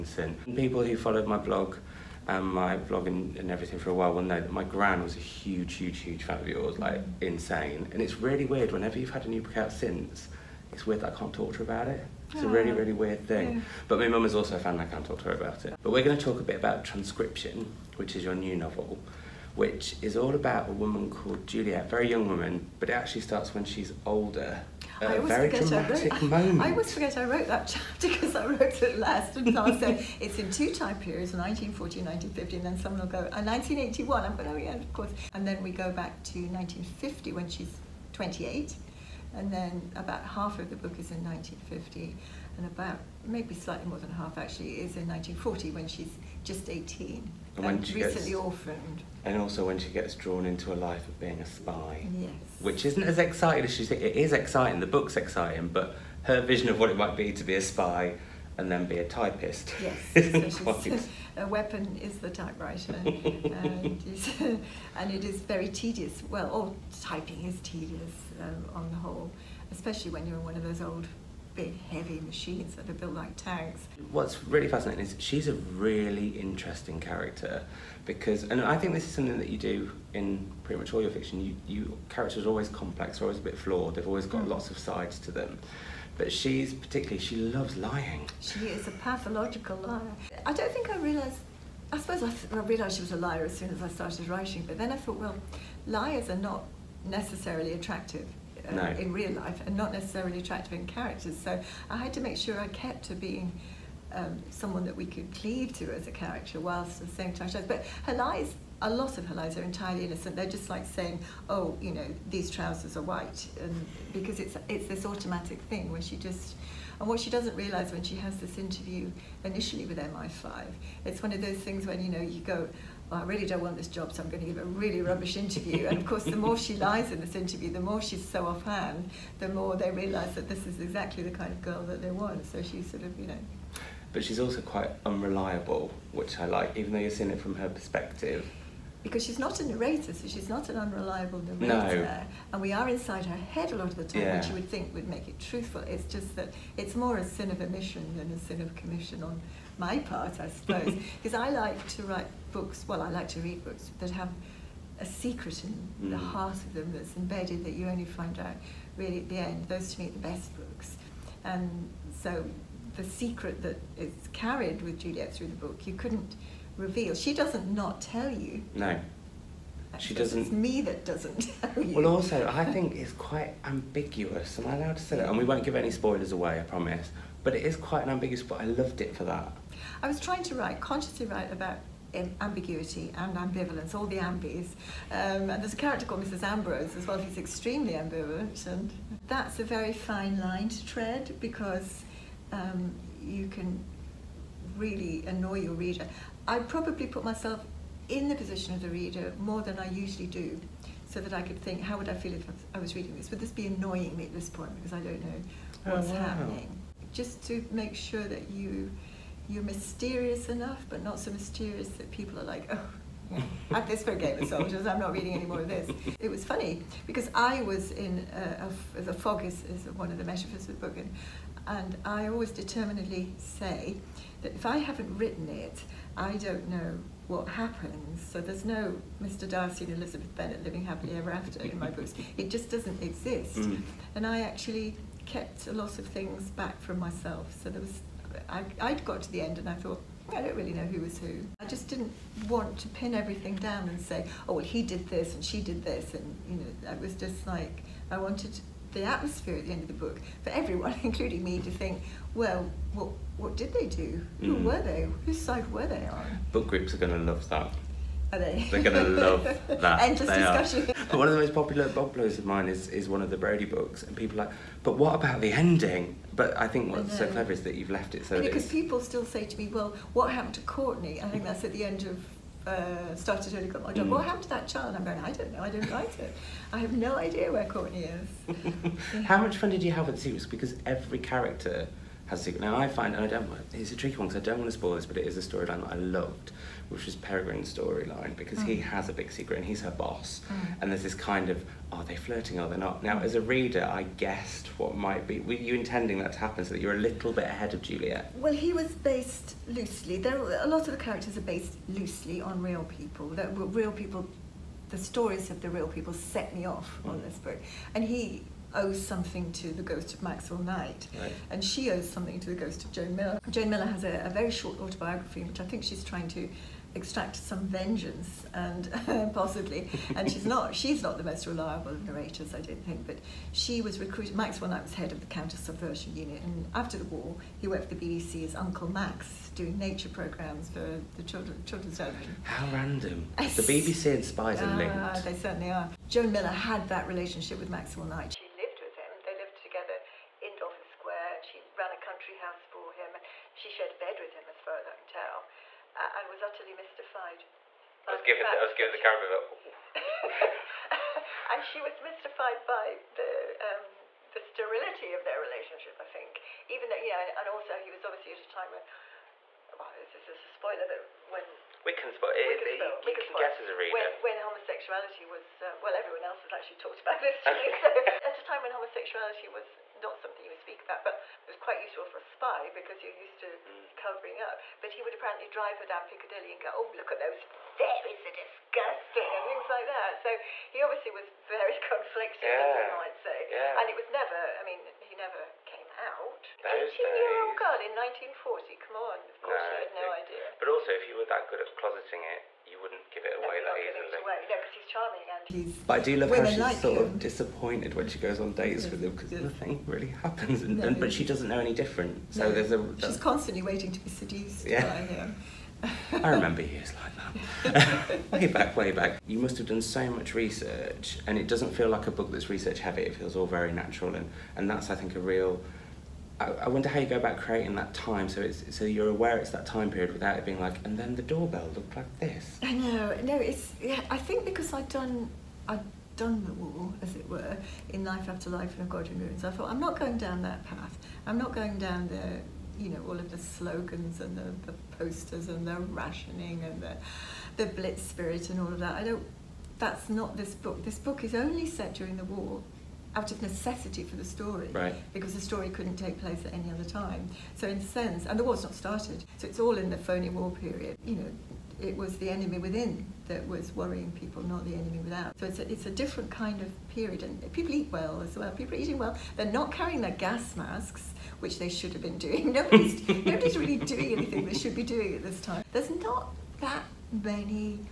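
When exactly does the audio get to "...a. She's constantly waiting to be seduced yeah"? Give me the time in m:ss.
6:42.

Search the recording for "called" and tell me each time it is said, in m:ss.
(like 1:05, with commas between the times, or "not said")
0:21, 3:06.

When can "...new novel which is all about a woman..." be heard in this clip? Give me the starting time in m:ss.
0:18.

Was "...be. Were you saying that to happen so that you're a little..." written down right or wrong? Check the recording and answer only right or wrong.
wrong.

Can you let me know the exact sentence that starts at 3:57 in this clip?
So there was I, I got to the end and I thought, I don't really know who was who.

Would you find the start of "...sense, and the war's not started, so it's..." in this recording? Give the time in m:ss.
7:27.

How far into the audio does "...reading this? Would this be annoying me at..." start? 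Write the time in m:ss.
3:22.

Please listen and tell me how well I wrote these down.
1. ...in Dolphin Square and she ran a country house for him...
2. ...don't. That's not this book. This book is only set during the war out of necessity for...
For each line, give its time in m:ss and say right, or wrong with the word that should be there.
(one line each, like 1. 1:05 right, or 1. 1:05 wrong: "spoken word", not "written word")
1. 5:40 right
2. 7:19 right.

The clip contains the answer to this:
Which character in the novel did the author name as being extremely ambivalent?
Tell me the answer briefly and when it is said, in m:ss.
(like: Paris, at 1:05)
Mrs. Ambrose, at 3:06.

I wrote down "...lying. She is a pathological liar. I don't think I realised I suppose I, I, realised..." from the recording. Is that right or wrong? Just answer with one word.
right.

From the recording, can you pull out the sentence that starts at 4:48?
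he has a big secret and he's her boss.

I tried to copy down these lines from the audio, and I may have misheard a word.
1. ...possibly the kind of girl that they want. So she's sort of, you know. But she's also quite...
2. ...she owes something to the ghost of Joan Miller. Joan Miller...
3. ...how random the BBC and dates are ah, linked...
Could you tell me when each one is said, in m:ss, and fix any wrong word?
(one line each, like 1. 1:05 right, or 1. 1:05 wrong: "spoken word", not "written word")
1. 2:10 wrong: "exactly", not "possibly"
2. 5:11 right
3. 5:32 wrong: "spies", not "dates".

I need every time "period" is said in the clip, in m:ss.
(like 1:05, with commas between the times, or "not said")
0:30, 6:59, 7:30, 7:36.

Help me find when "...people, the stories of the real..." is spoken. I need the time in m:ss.
5:03.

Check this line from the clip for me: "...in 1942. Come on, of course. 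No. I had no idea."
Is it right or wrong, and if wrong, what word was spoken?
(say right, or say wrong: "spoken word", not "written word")
wrong: "1940", not "1942".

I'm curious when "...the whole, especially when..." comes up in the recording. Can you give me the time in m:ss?
1:08.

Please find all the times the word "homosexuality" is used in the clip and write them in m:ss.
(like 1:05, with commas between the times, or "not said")
6:04, 6:08.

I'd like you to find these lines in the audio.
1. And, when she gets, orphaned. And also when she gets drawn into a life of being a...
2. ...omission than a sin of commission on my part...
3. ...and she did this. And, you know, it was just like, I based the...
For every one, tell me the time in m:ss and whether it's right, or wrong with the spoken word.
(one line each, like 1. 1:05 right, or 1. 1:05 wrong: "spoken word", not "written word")
1. 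0:47 right
2. 2:27 right
3. 4:05 wrong: "wanted", not "based".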